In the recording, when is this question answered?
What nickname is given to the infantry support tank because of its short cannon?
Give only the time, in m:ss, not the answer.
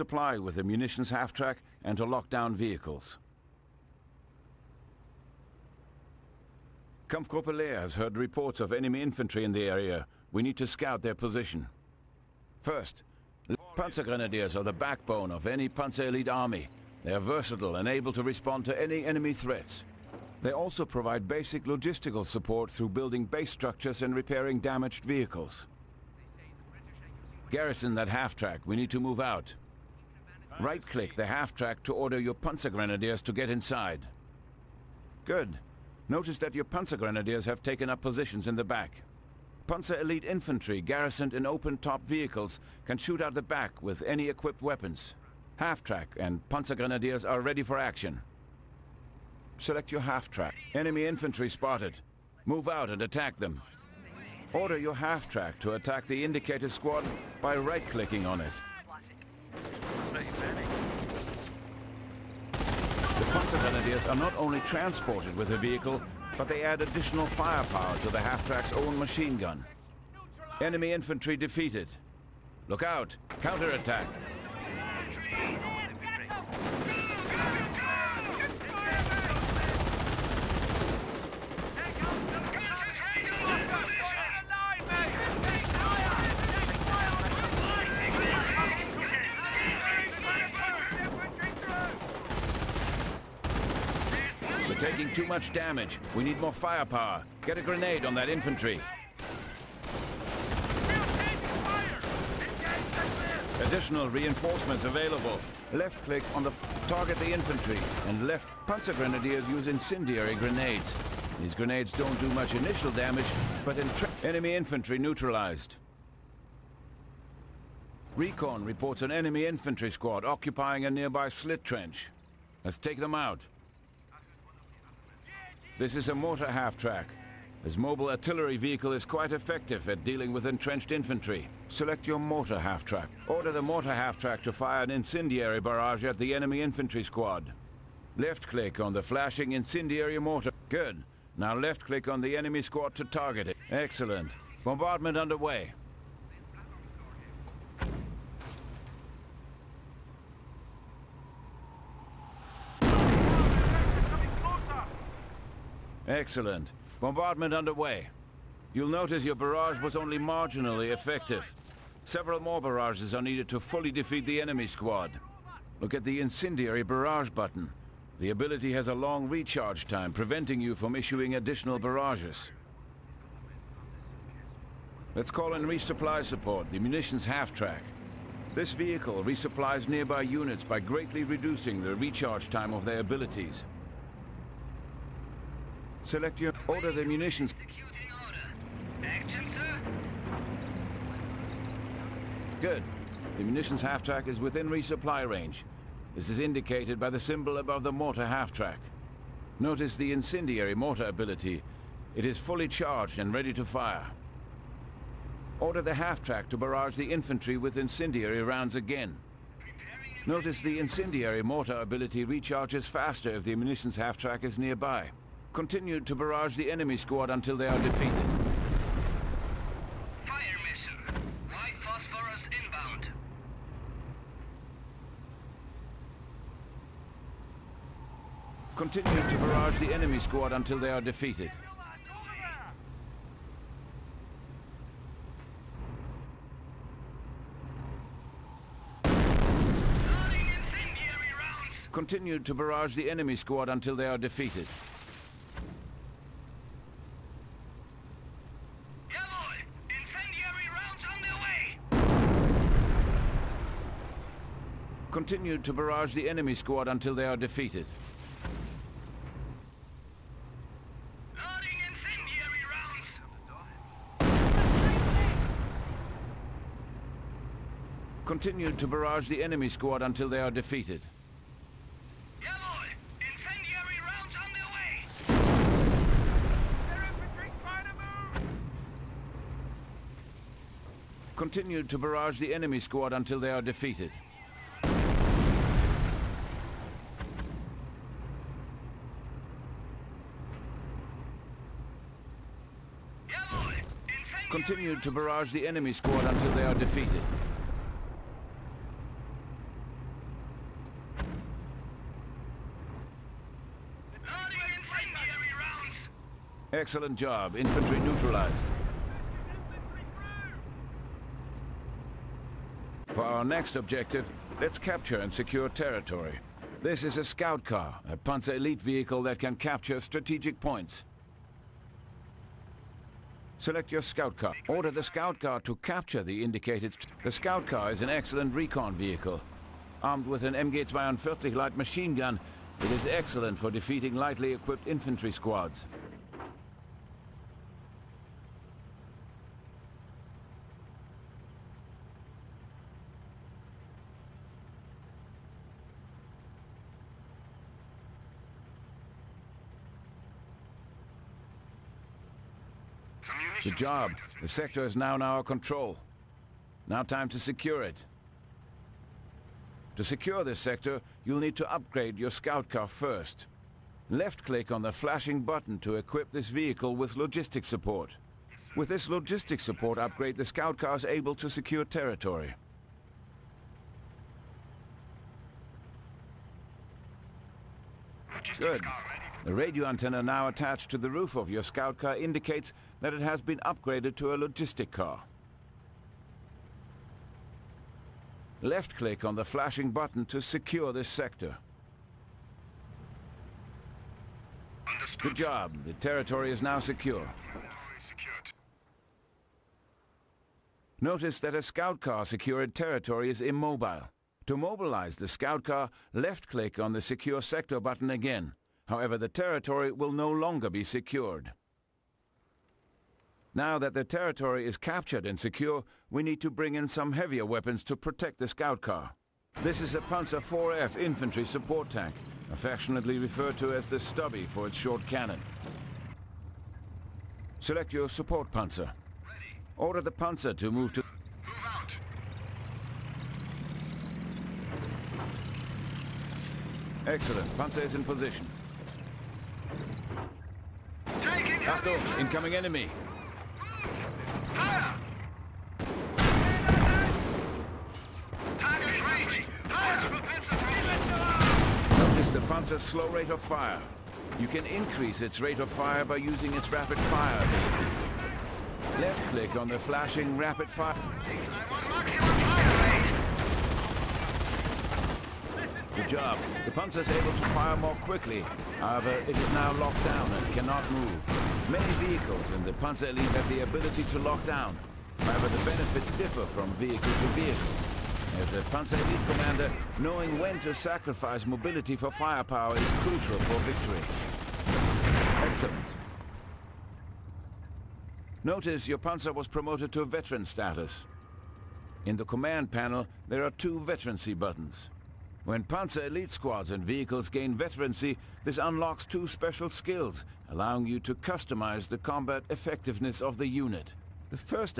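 7:03.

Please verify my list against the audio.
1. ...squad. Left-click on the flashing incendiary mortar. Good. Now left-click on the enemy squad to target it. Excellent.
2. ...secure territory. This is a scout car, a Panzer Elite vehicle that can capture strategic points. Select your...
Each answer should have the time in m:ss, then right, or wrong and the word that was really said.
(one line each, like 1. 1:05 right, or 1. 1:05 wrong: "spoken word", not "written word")
1. 2:17 right
2. 5:15 right.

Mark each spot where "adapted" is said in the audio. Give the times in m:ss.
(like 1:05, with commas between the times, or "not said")
not said.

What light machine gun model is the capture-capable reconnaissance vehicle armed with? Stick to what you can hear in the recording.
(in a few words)
MG-42.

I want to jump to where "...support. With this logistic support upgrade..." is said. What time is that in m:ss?
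6:07.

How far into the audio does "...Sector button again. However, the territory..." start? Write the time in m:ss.
6:47.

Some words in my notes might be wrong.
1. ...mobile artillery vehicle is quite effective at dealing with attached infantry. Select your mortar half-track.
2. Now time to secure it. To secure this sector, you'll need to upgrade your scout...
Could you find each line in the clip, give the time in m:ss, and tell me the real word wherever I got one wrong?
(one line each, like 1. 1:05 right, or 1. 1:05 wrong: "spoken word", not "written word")
1. 2:07 wrong: "entrenched", not "attached"
2. 5:56 right.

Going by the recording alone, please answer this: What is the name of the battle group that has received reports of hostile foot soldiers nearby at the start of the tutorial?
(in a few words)
Kampfgruppe Lehr.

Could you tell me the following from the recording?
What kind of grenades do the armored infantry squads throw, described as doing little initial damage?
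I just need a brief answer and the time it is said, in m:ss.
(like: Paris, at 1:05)
Incendiary grenades, at 1:49.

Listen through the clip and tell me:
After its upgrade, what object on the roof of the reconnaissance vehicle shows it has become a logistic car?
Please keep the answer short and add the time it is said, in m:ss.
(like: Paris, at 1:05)
Radio antenna, at 6:19.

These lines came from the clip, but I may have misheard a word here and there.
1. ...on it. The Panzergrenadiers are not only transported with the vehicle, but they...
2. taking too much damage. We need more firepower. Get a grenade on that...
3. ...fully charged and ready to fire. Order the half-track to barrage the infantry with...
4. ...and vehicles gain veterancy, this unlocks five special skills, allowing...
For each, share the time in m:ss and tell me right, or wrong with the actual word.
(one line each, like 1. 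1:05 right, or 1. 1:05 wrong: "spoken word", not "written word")
1. 0:58 right
2. 1:34 right
3. 3:22 right
4. 8:16 wrong: "two", not "five".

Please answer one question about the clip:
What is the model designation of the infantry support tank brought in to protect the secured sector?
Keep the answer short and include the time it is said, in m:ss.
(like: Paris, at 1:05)
Panzer IV-F, at 7:00.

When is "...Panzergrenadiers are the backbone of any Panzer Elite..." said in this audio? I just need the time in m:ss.
0:13.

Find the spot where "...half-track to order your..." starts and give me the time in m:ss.
0:31.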